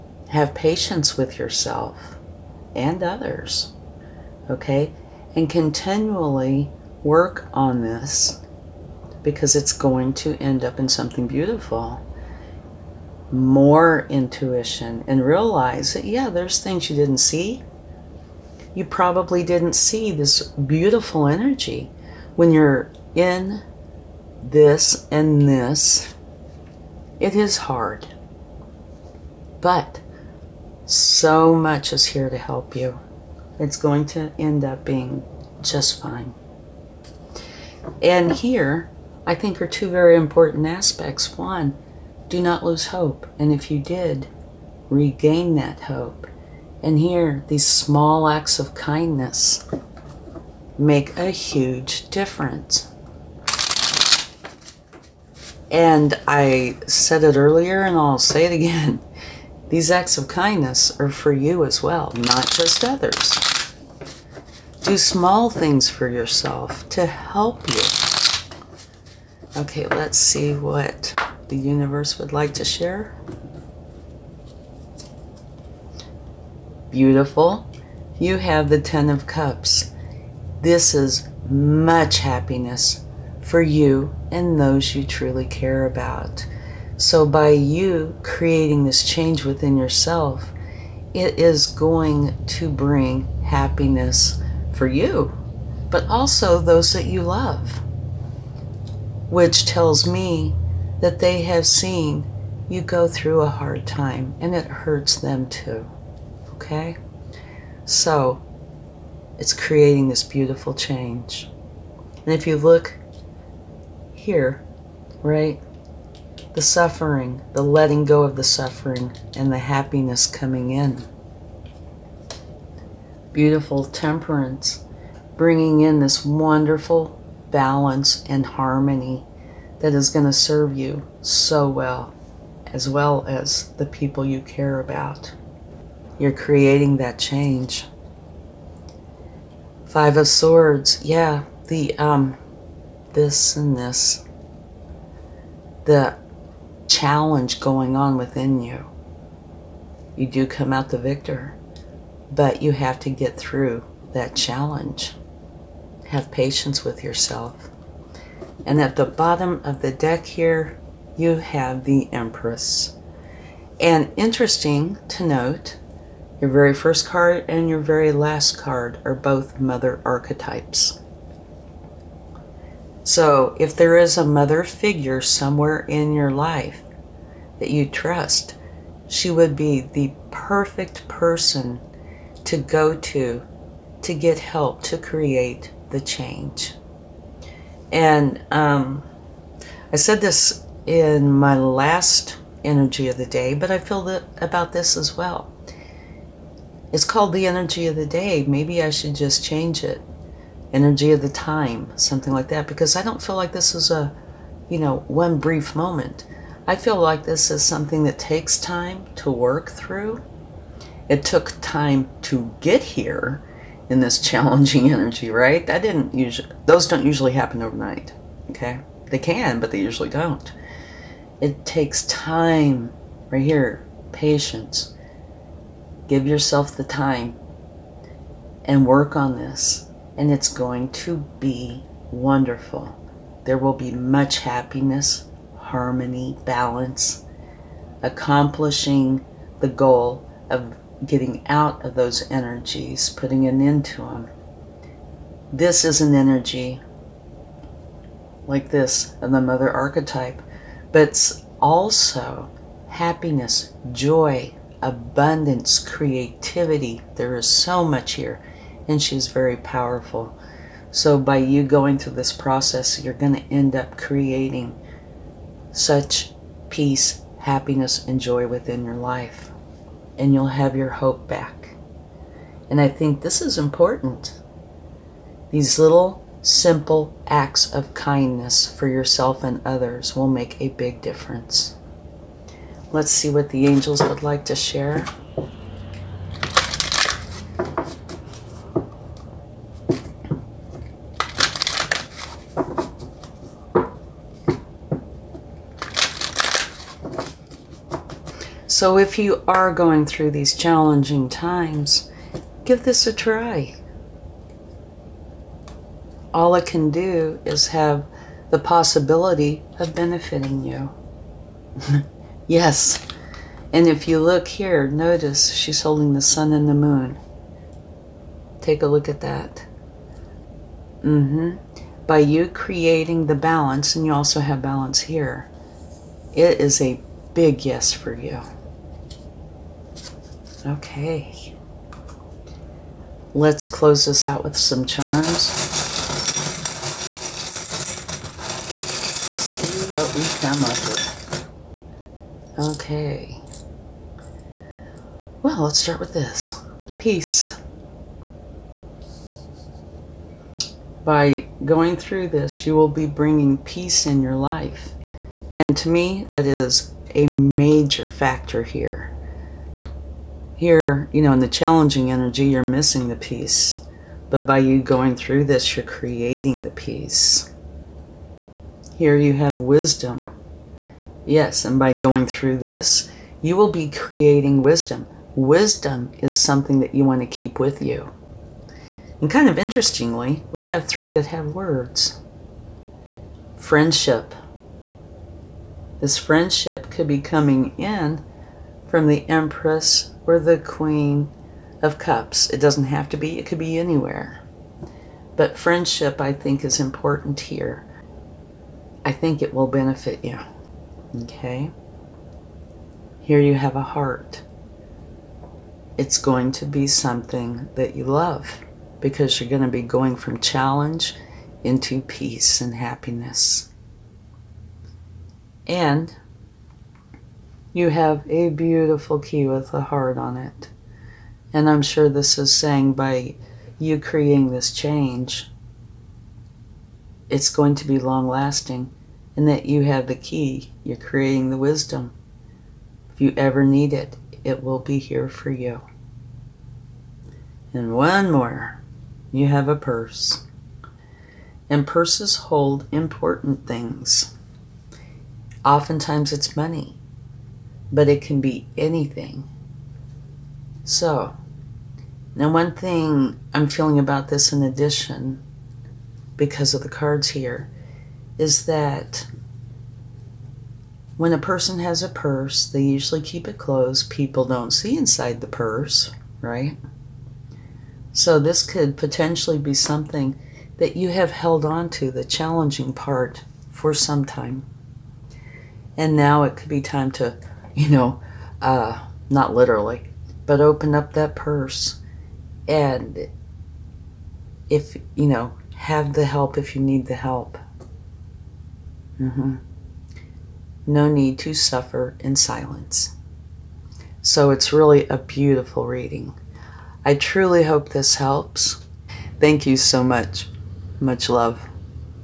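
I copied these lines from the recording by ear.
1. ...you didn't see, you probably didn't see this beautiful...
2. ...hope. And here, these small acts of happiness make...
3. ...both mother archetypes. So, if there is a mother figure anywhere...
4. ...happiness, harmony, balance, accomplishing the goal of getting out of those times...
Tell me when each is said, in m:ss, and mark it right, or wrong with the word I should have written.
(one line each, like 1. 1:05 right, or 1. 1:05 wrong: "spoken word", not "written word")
1. 0:16 right
2. 0:45 wrong: "kindness", not "happiness"
3. 2:49 wrong: "somewhere", not "anywhere"
4. 3:54 wrong: "energies", not "times".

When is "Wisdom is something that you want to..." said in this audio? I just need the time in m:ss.
6:15.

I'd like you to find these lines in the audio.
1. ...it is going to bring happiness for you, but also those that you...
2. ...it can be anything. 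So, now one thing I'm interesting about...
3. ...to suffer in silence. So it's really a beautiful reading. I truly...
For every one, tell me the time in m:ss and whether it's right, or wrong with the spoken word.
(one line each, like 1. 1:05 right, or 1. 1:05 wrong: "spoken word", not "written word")
1. 1:31 right
2. 7:28 wrong: "feeling", not "interesting"
3. 8:11 right.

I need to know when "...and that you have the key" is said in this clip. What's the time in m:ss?
7:09.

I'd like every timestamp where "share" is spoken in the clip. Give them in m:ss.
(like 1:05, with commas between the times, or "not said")
1:12, 4:44.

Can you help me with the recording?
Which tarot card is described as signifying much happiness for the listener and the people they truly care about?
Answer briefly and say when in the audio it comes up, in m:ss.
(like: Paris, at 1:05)
Ten of Cups, at 1:18.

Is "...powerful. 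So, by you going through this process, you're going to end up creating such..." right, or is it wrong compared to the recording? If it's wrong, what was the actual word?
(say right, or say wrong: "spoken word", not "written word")
right.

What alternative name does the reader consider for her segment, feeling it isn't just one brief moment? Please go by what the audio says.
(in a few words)
Energy of the time.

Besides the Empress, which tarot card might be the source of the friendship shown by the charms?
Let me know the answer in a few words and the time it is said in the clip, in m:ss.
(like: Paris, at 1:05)
Queen of Cups, at 6:30.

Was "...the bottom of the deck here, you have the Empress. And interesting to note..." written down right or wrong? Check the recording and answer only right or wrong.
right.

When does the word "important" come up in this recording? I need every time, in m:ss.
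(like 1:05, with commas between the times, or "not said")
0:40, 4:33, 6:36, 7:22.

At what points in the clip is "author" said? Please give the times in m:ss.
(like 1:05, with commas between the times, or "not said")
not said.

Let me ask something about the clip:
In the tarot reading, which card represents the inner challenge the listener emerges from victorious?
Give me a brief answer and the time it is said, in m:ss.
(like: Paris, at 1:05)
Five of Swords, at 2:19.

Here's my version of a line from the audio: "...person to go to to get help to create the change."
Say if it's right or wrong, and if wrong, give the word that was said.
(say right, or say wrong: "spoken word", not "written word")
right.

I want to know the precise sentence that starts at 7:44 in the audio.
People don't see inside the purse, right?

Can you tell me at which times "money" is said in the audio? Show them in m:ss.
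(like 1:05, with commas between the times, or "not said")
7:26.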